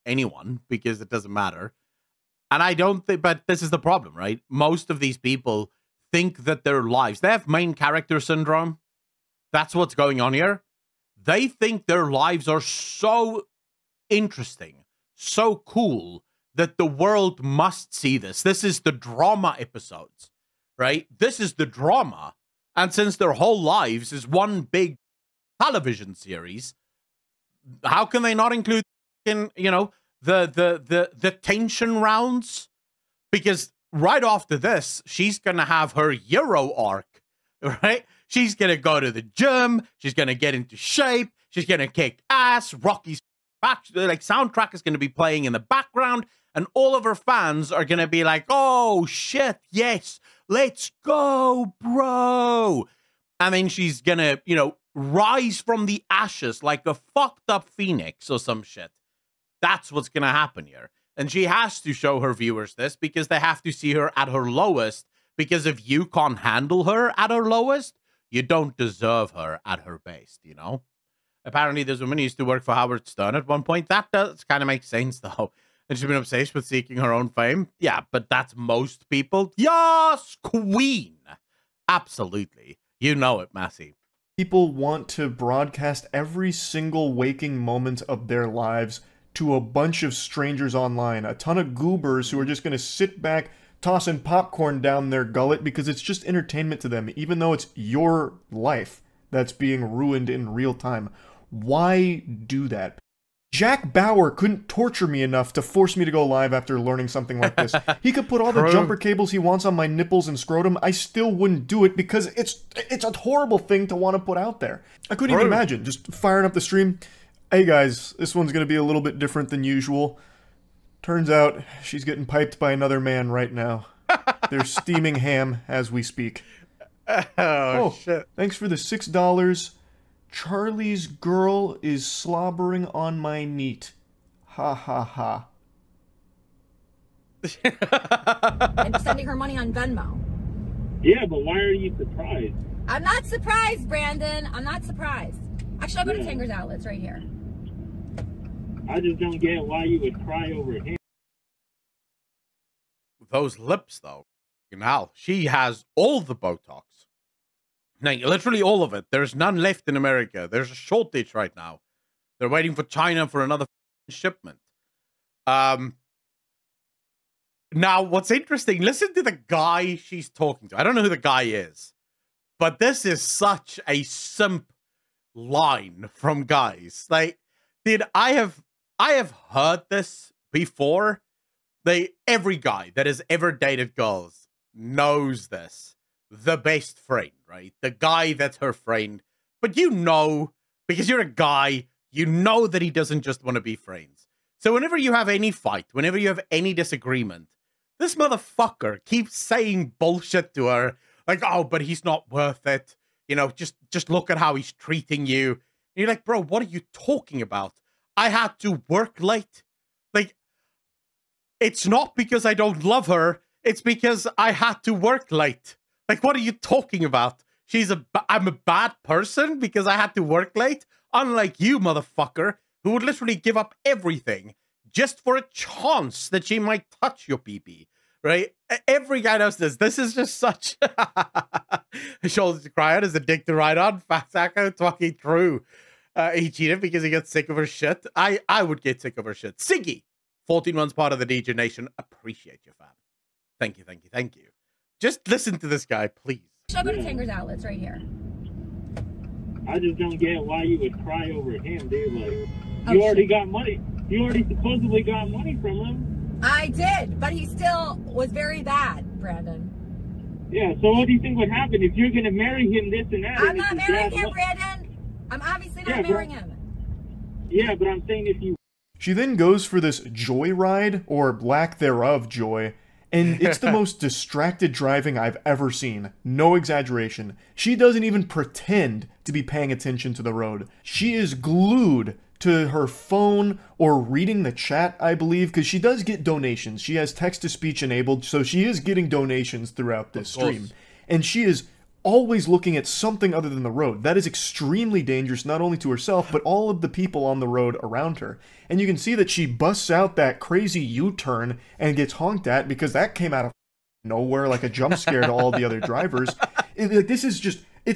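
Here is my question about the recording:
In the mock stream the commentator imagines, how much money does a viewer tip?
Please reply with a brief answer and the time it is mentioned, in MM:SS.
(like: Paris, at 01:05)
$6, at 02:08.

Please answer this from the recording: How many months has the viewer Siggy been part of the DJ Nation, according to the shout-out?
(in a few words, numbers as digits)
14.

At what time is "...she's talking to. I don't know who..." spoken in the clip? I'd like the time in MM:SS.
02:49.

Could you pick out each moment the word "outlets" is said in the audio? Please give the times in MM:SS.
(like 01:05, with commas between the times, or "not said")
02:26, 04:07.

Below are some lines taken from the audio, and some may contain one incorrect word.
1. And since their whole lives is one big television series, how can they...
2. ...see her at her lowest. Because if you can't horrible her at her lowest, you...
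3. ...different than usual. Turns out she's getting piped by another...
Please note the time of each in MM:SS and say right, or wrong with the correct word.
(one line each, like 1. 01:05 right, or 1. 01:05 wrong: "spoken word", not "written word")
1. 00:22 right
2. 01:03 wrong: "handle", not "horrible"
3. 01:59 right.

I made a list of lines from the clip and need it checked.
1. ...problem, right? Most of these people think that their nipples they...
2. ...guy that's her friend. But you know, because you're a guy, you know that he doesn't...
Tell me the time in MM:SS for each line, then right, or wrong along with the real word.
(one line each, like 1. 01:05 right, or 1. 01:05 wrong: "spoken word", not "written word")
1. 00:03 wrong: "lives", not "nipples"
2. 03:07 right.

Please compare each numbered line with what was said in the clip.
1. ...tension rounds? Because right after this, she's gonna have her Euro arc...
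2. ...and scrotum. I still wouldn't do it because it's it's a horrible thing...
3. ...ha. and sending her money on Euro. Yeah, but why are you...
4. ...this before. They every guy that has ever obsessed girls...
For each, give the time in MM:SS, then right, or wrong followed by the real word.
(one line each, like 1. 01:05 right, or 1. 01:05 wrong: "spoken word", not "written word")
1. 00:31 right
2. 01:50 right
3. 02:15 wrong: "Venmo", not "Euro"
4. 02:59 wrong: "dated", not "obsessed".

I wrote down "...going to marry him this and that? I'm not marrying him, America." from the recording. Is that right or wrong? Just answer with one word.
wrong.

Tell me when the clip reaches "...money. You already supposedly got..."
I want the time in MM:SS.
04:13.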